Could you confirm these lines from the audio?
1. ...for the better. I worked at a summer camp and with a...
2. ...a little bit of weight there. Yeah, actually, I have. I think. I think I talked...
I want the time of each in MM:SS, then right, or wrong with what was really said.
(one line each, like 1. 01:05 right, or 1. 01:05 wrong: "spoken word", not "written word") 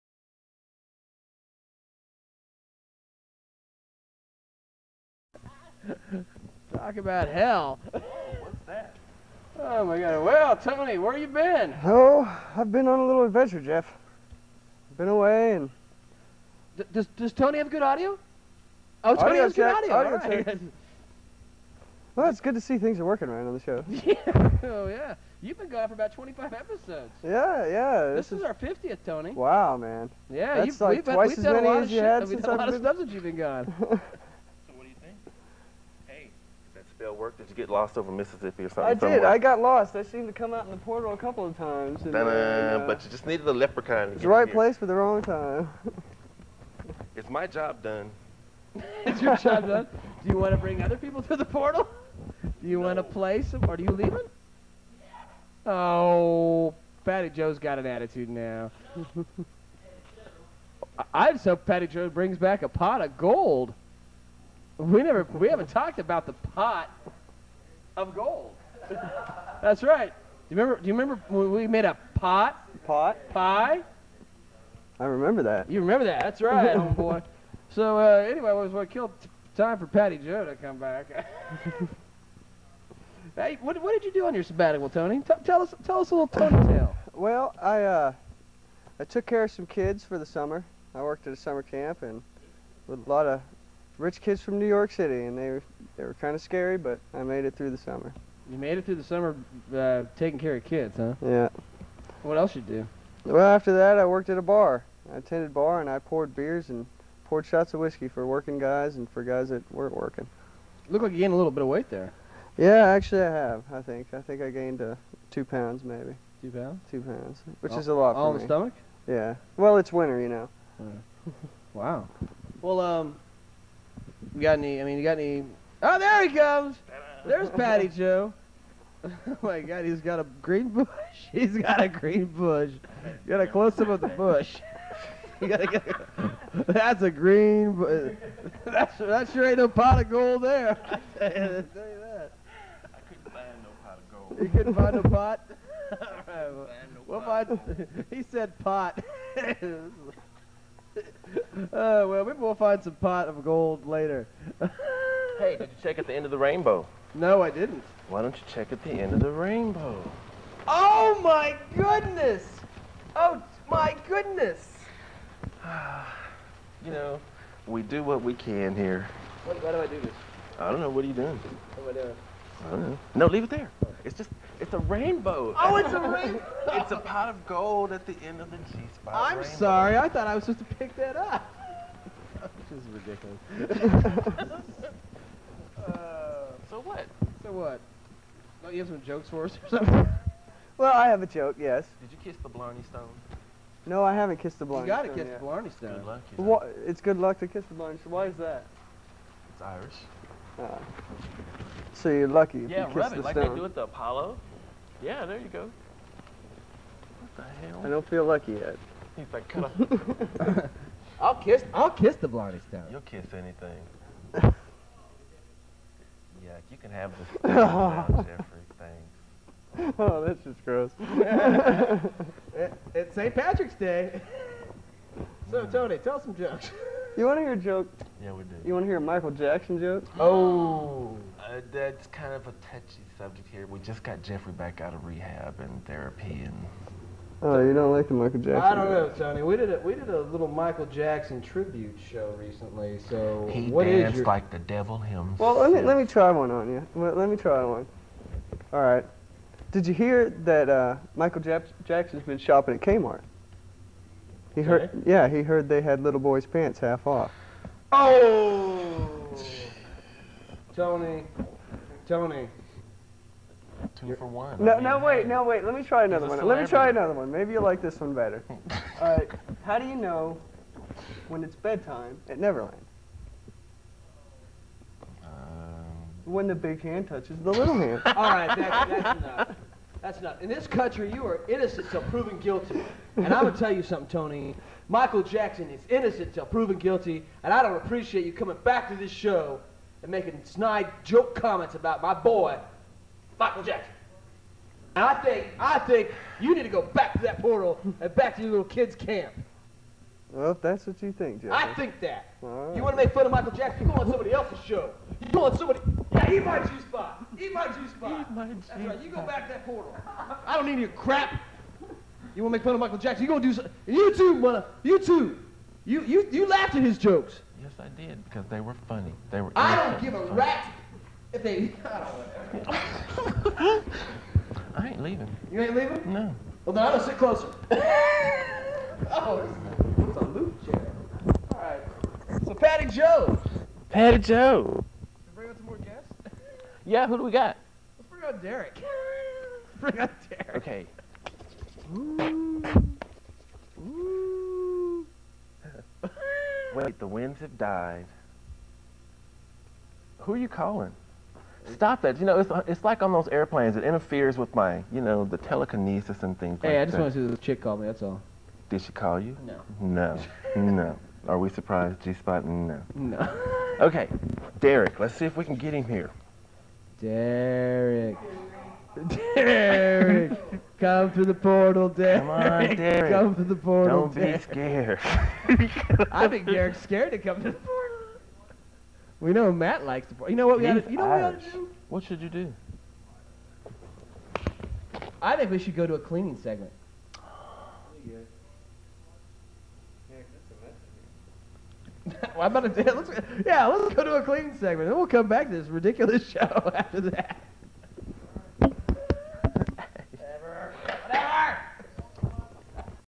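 1. 01:30 wrong: "summer", not "better"
2. 01:51 wrong: "gained", not "talked".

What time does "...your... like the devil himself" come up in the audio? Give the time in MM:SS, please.
04:04.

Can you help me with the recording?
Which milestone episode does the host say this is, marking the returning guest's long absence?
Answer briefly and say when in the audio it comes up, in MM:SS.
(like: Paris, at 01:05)
50th, at 00:28.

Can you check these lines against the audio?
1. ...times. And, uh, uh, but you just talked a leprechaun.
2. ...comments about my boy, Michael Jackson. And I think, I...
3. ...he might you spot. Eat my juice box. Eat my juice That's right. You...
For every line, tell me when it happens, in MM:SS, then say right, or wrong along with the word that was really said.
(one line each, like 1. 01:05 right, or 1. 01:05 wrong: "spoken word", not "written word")
1. 00:41 wrong: "needed", not "talked"
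2. 04:51 right
3. 05:06 right.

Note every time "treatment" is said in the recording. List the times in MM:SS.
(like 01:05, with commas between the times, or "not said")
not said.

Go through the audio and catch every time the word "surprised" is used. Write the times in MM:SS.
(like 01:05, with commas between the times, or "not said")
06:01.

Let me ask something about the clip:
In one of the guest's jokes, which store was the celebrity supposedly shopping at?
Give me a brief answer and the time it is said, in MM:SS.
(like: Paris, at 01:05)
Kmart, at 04:12.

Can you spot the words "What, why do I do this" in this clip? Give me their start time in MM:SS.
02:49.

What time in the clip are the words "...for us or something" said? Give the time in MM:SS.
03:09.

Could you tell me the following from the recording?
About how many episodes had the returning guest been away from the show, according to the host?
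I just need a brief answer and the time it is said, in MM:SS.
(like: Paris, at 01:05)
25, at 00:26.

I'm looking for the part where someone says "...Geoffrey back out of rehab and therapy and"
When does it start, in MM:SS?
03:54.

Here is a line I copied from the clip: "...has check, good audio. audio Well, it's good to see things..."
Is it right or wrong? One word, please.
right.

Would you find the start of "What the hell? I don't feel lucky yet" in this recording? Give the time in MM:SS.
03:27.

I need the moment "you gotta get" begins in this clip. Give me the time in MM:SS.
02:15.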